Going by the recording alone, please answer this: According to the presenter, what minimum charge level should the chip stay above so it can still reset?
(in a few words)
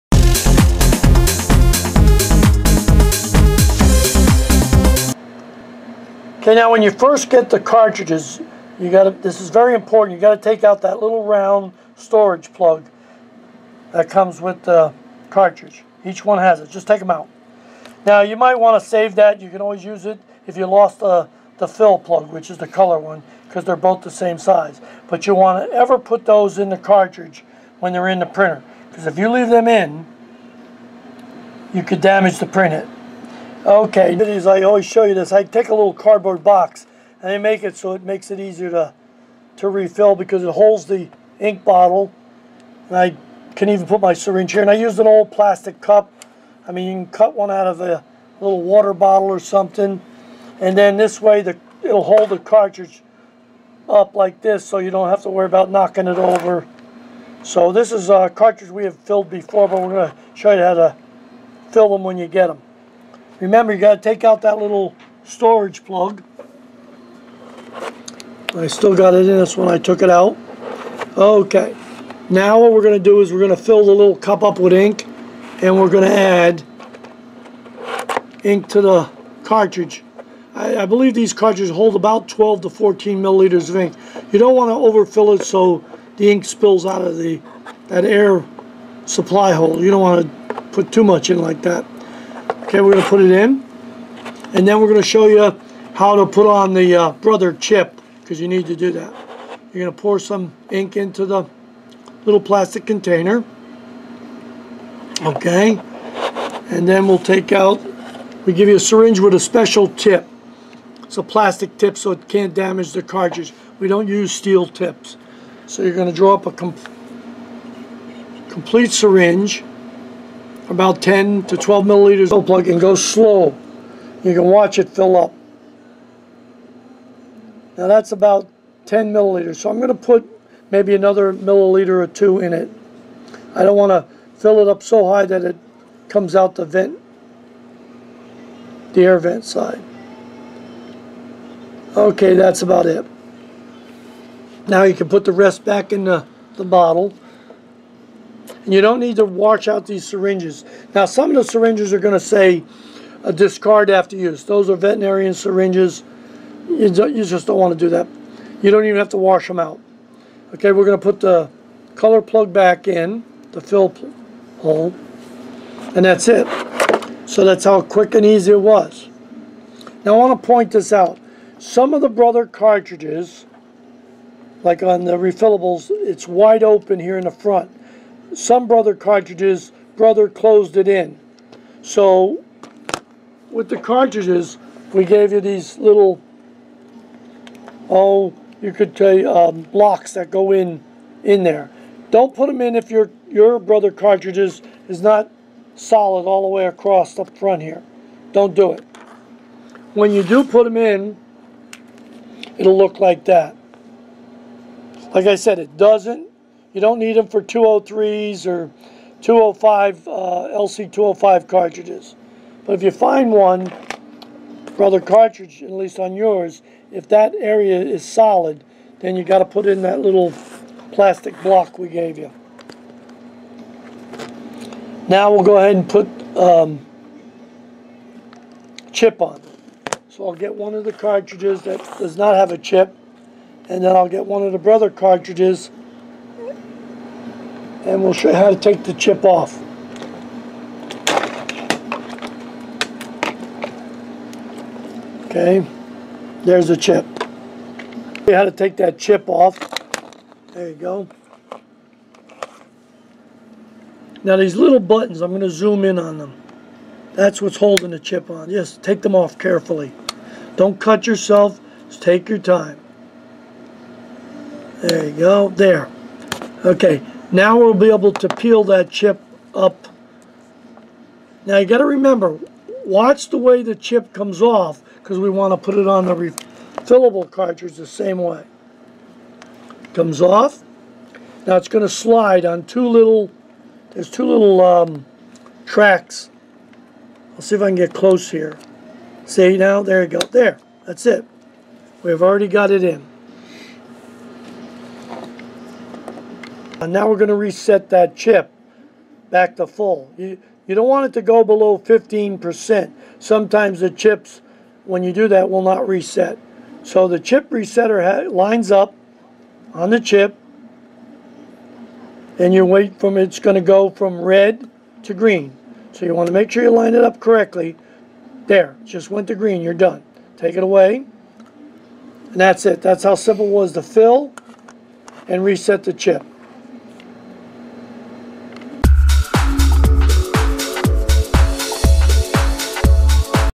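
15%.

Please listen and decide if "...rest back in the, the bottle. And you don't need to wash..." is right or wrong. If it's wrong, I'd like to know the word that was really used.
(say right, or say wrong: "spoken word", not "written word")
right.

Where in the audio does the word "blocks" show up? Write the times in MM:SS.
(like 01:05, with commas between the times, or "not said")
03:09, 03:41.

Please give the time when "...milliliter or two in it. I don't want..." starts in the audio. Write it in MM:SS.
02:11.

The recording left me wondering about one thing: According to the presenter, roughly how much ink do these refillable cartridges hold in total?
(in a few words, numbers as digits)
12 to 14 milliliters.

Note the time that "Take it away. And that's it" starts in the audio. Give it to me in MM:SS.
05:20.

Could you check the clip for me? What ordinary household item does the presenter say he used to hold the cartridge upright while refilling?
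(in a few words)
old plastic cup.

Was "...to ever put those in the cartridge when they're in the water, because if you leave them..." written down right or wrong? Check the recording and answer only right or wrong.
wrong.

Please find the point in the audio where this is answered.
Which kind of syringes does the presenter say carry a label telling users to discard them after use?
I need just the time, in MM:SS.
02:34.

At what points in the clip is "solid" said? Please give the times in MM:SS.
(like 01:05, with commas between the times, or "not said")
03:15, 03:38.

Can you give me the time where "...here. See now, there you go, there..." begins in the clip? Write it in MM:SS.
04:48.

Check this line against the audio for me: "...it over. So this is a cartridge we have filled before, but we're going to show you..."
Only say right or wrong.
right.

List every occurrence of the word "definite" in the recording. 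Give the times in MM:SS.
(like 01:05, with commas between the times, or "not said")
not said.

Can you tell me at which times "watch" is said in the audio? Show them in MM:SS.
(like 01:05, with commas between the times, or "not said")
02:04, 04:32.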